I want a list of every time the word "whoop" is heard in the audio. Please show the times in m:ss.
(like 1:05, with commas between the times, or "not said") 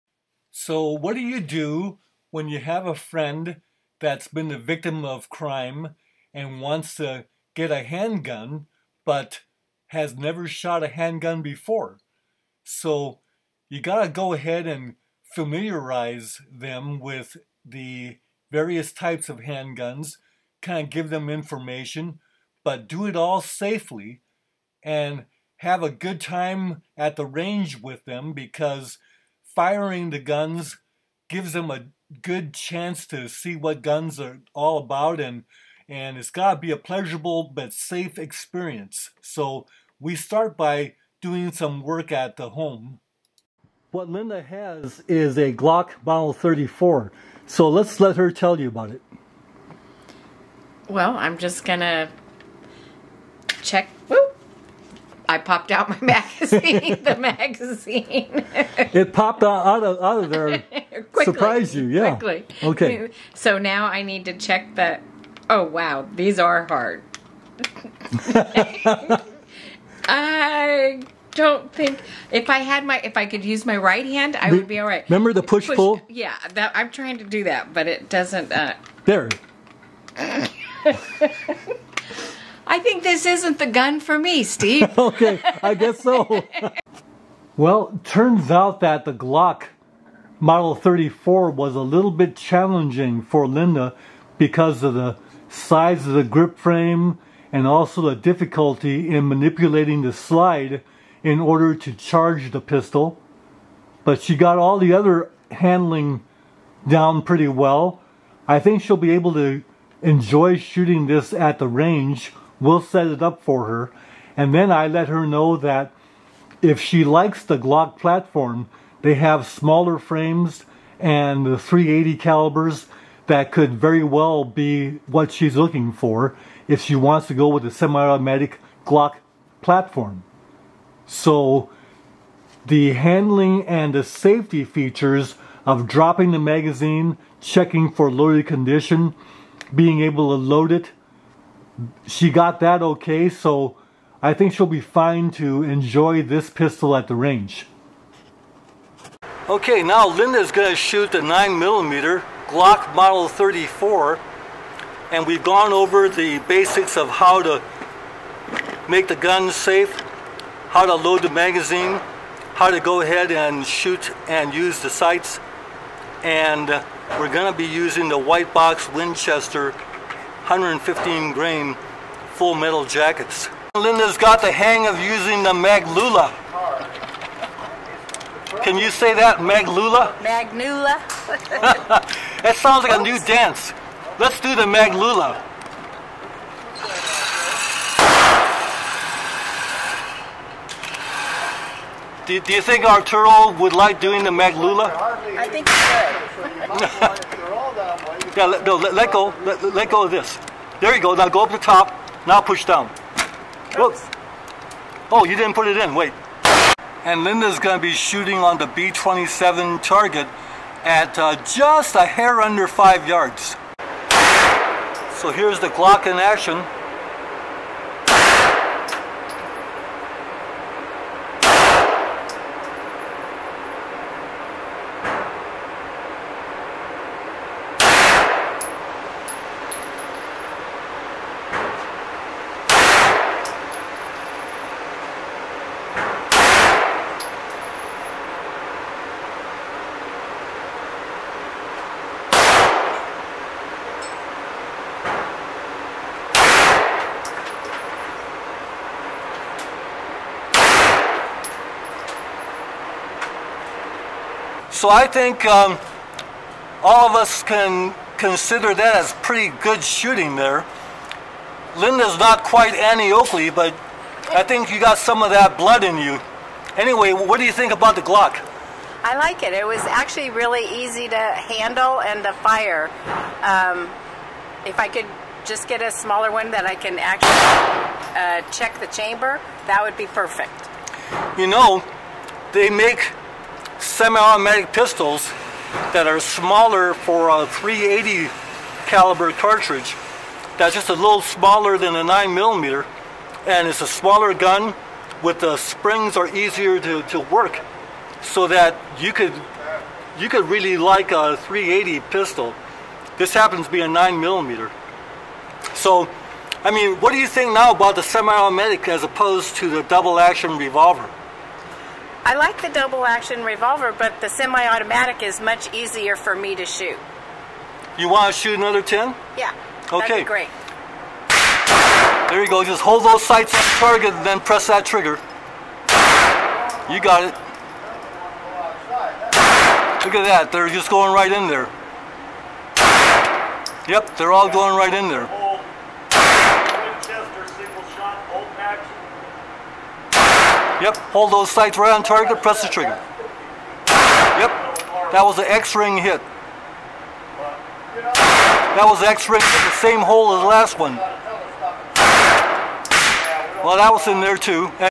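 0:54, 3:23.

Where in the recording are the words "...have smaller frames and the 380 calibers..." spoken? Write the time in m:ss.
1:59.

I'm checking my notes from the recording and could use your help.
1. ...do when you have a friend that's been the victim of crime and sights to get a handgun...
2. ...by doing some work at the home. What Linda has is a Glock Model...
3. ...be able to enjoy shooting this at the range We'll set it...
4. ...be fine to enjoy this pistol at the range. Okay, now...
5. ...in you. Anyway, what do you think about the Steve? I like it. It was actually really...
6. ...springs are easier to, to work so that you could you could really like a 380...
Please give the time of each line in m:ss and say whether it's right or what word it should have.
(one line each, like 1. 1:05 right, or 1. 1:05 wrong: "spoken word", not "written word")
1. 0:01 wrong: "wants", not "sights"
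2. 0:40 right
3. 1:48 right
4. 2:24 right
5. 4:25 wrong: "Glock", not "Steve"
6. 4:55 right.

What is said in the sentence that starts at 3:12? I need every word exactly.
Do, do you think Arturo would like doing the Maglula?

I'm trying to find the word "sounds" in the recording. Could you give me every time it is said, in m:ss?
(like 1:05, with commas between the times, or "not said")
3:02.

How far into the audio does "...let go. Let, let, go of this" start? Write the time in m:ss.
3:18.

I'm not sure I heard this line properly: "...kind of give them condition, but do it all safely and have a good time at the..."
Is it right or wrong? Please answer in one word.
wrong.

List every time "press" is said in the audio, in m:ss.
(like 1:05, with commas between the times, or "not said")
5:24, 5:42.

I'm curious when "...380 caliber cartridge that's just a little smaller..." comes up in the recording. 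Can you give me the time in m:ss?
4:47.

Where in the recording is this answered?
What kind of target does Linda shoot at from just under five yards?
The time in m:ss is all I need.
3:28.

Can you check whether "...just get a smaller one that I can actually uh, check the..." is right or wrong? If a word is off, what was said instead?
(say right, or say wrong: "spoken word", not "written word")
right.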